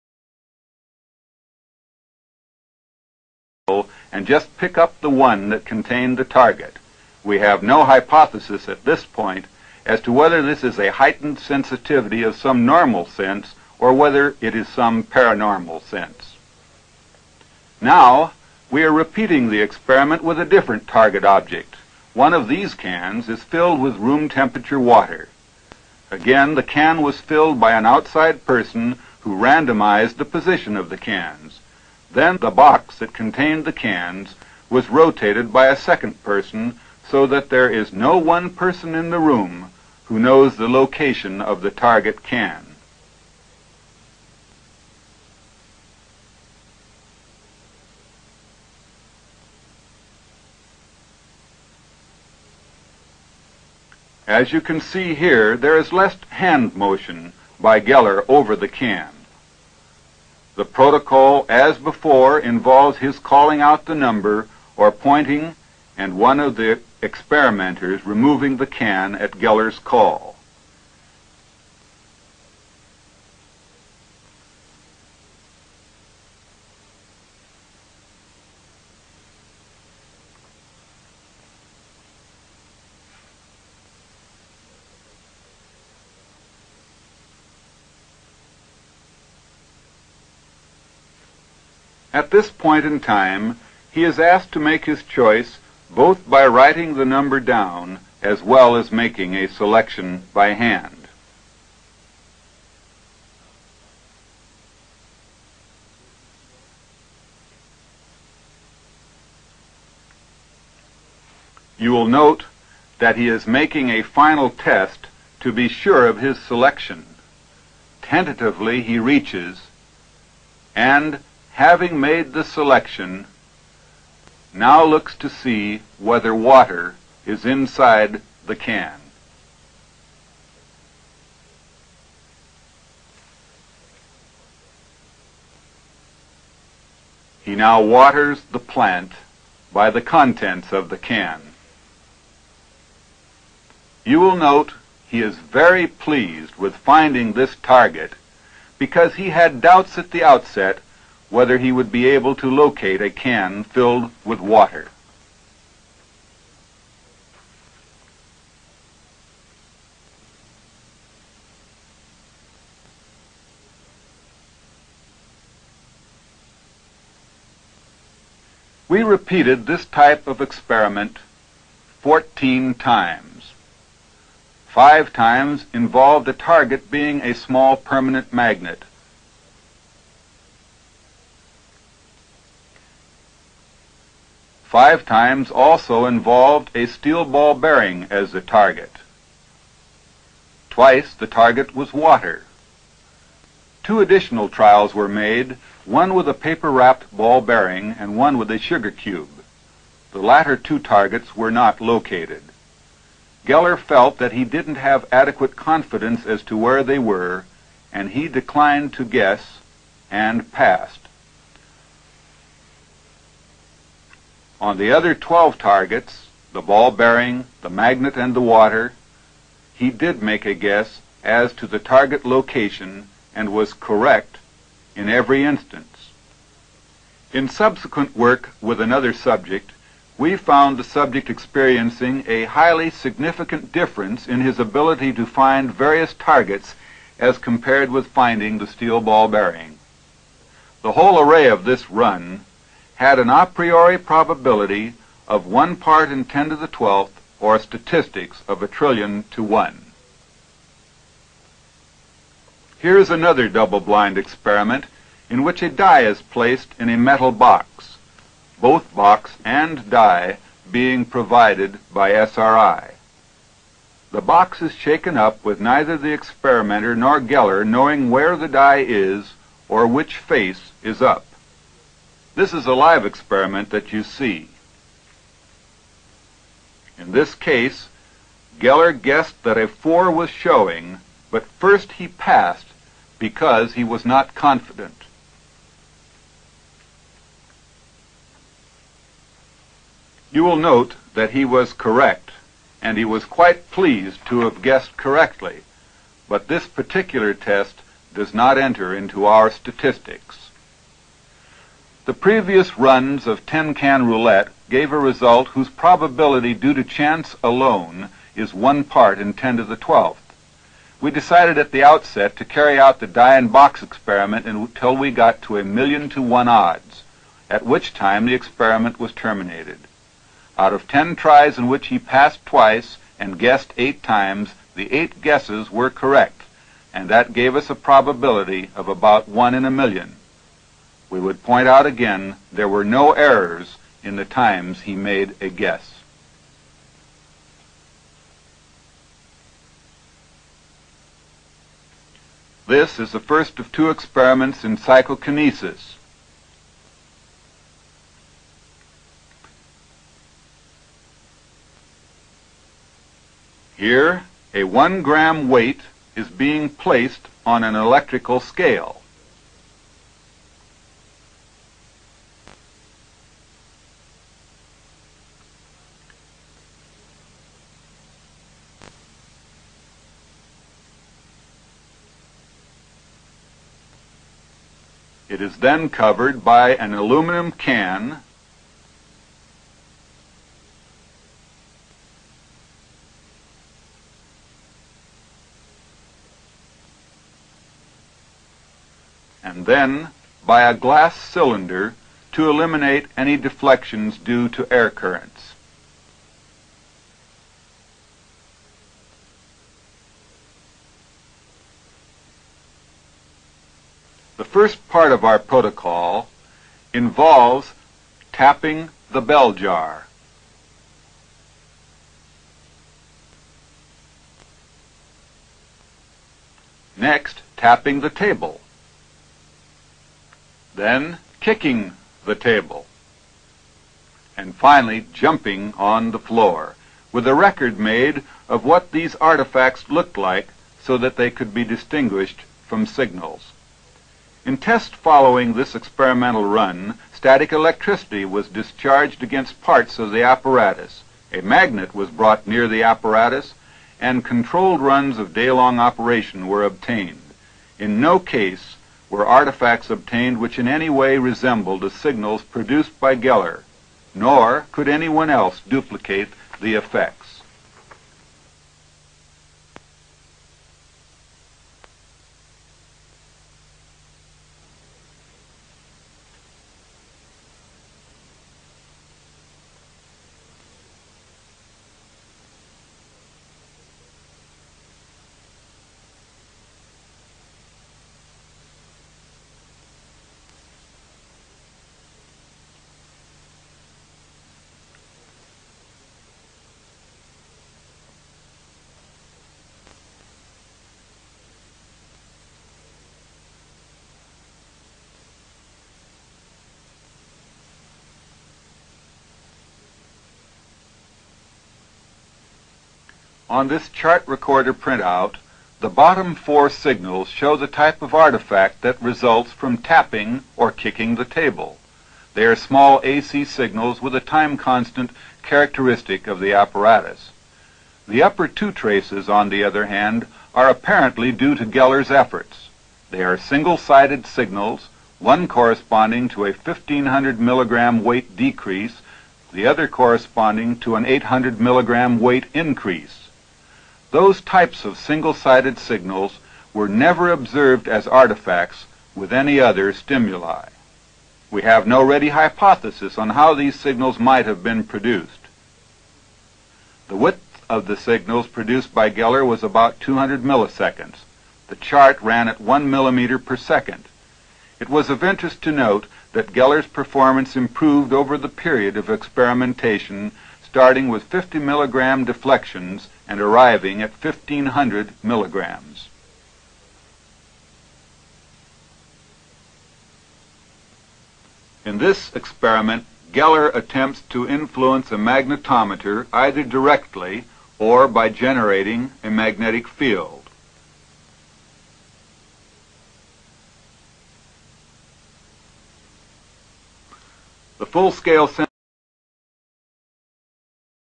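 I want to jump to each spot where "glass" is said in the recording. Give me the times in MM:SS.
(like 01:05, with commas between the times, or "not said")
06:30.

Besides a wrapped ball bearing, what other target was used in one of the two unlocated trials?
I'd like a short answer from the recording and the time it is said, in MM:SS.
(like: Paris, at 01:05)
sugar cube, at 03:18.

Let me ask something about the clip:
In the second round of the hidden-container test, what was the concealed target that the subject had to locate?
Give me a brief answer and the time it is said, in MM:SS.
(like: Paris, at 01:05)
room temperature water, at 00:23.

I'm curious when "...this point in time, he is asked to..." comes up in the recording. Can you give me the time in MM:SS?
01:32.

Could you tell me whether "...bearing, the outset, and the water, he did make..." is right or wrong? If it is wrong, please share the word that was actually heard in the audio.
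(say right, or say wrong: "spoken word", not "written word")
wrong: "magnet", not "outset".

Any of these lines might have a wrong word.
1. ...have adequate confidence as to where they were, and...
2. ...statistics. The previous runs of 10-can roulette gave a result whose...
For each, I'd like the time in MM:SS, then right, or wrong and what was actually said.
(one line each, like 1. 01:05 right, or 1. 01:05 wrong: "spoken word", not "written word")
1. 03:24 right
2. 04:59 right.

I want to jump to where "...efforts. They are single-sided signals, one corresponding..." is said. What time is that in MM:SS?
08:42.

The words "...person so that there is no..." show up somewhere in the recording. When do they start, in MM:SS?
00:36.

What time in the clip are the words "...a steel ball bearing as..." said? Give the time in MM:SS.
03:06.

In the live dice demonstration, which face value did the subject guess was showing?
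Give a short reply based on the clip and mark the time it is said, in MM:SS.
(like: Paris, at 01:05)
4, at 04:39.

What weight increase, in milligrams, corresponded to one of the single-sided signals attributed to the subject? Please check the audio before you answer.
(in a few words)
800 milligrams.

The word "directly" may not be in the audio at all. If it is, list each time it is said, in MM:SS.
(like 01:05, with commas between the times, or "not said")
09:36.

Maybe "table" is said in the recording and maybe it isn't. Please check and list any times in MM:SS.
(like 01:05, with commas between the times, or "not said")
06:58, 07:02, 08:31.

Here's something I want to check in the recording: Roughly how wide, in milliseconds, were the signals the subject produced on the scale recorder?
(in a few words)
200 milliseconds.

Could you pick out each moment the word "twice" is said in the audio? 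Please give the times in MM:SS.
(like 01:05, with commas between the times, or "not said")
03:10, 05:22.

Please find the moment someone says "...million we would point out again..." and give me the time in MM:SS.
05:29.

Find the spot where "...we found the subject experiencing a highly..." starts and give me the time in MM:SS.
03:50.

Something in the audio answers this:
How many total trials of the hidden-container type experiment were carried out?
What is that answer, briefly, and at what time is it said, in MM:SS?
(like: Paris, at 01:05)
14, at 02:52.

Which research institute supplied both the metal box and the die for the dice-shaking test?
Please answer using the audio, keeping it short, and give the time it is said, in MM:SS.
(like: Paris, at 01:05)
SRI, at 04:22.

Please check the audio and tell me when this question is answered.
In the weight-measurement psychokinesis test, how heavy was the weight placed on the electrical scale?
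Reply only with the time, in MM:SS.
05:54.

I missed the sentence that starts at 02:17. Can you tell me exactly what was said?
He now waters the plant by the contents of the can.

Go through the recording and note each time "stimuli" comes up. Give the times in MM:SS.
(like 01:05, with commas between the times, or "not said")
08:59.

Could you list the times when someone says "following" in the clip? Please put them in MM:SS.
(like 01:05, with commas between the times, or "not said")
07:14.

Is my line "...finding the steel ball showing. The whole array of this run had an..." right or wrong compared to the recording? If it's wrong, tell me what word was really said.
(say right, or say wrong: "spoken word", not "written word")
wrong: "bearing", not "showing".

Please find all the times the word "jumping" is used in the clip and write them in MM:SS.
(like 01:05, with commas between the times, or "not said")
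07:05.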